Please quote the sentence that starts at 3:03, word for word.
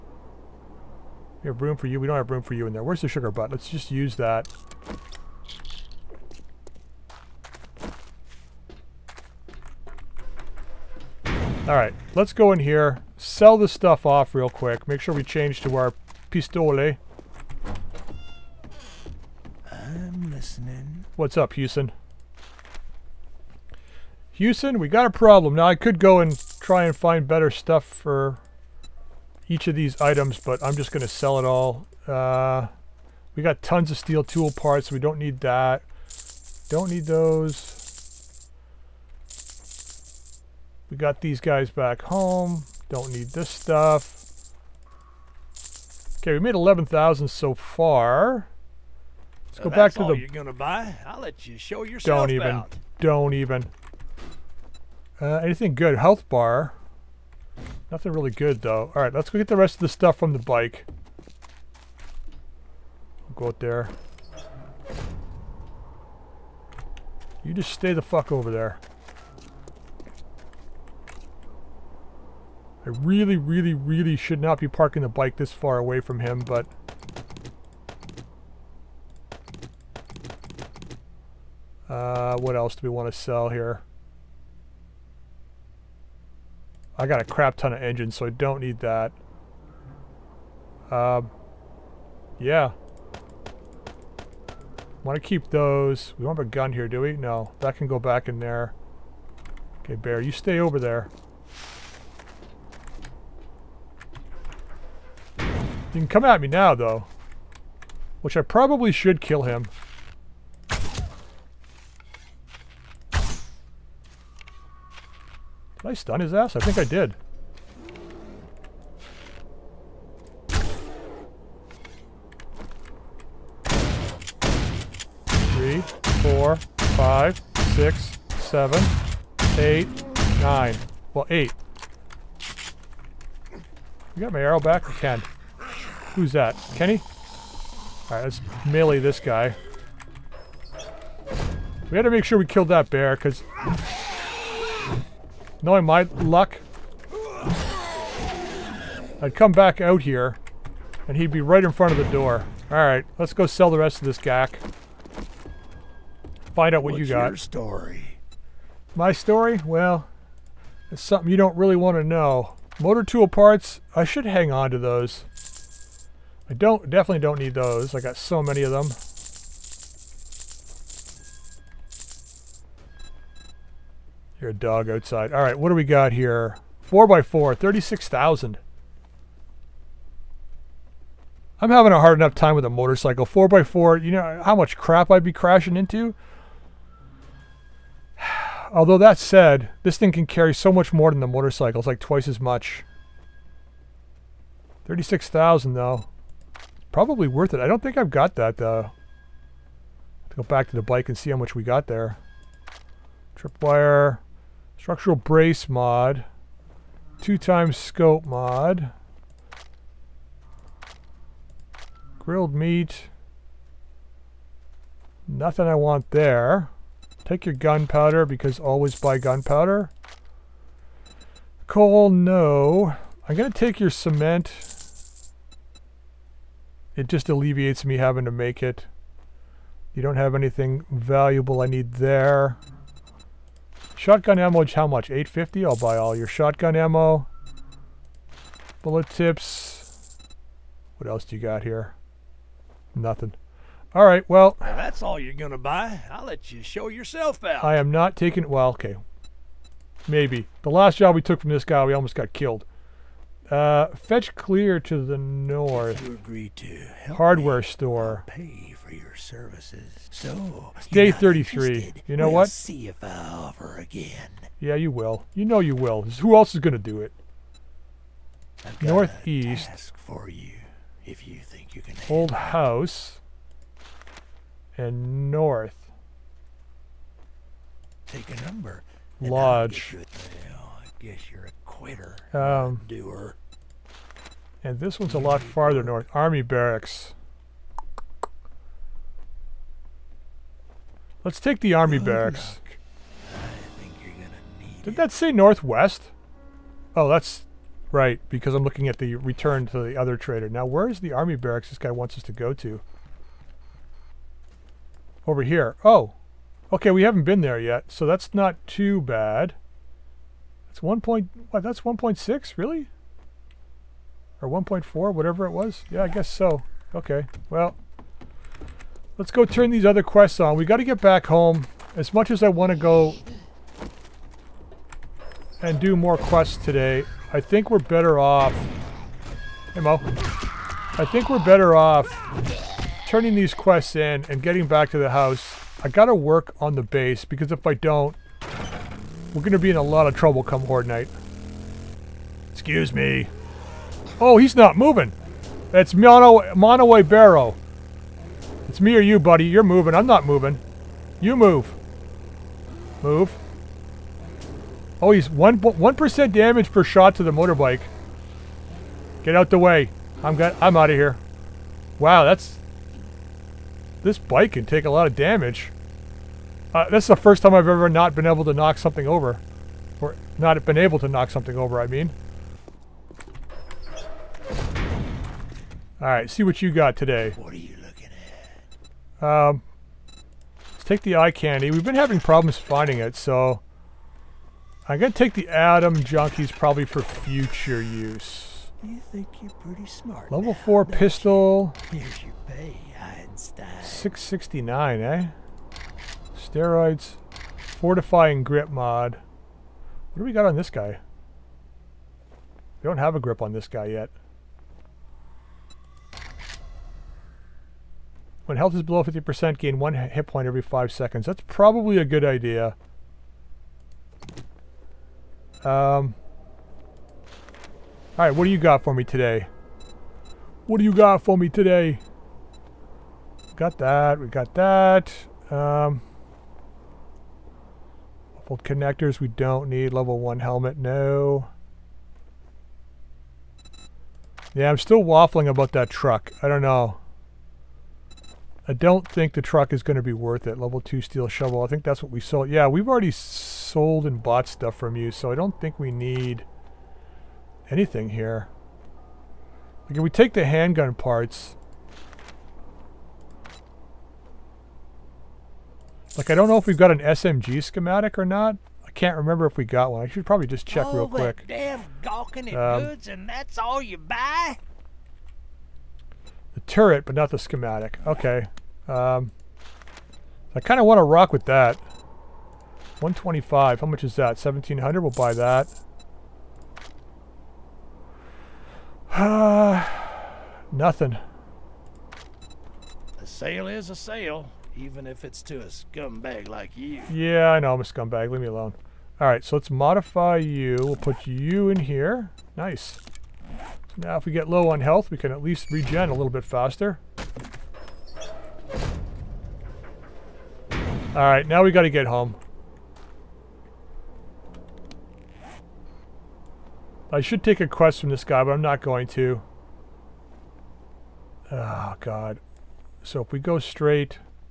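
4x4, you know how much crap I'd be crashing into?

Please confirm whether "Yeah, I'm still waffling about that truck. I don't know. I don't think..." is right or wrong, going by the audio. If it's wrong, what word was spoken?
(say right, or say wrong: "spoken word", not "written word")
right.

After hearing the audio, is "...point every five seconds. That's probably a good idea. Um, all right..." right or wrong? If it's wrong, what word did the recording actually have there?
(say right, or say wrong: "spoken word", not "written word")
right.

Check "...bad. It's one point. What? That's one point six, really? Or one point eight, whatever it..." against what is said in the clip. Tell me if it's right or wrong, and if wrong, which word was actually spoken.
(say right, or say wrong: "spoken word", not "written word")
wrong: "four", not "eight".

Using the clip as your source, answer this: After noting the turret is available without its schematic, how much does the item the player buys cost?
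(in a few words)
1700.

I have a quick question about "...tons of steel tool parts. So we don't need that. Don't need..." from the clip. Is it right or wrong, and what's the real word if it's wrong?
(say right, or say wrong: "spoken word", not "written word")
right.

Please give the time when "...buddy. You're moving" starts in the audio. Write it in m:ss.
5:49.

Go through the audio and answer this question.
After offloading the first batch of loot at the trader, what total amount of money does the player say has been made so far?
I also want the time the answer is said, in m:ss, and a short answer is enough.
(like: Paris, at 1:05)
11,000, at 0:46.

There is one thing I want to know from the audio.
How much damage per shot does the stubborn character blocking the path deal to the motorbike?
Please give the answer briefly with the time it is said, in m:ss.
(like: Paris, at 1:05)
1, at 5:55.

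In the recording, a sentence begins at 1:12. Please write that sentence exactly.
I really, really, really should not be parking the bike this far away from him, but...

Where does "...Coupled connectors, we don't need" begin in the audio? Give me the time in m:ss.
7:08.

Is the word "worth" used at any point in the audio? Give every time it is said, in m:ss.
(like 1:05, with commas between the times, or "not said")
3:17, 7:20.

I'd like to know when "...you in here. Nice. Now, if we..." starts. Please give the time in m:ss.
8:11.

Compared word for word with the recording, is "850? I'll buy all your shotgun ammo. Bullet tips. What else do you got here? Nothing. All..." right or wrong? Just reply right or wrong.
right.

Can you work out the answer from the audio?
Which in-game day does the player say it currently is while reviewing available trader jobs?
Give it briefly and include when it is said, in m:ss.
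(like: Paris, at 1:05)
Day 33, at 4:20.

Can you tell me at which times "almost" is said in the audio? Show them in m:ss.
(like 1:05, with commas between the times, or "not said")
4:11.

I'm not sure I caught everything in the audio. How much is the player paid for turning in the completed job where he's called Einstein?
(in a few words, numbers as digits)
669.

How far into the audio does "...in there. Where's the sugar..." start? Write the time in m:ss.
0:02.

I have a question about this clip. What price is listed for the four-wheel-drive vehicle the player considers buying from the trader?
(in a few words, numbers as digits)
36,000.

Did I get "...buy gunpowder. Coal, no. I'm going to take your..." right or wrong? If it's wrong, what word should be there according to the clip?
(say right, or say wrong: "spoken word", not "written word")
right.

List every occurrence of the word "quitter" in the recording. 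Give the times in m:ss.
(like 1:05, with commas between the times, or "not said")
4:41.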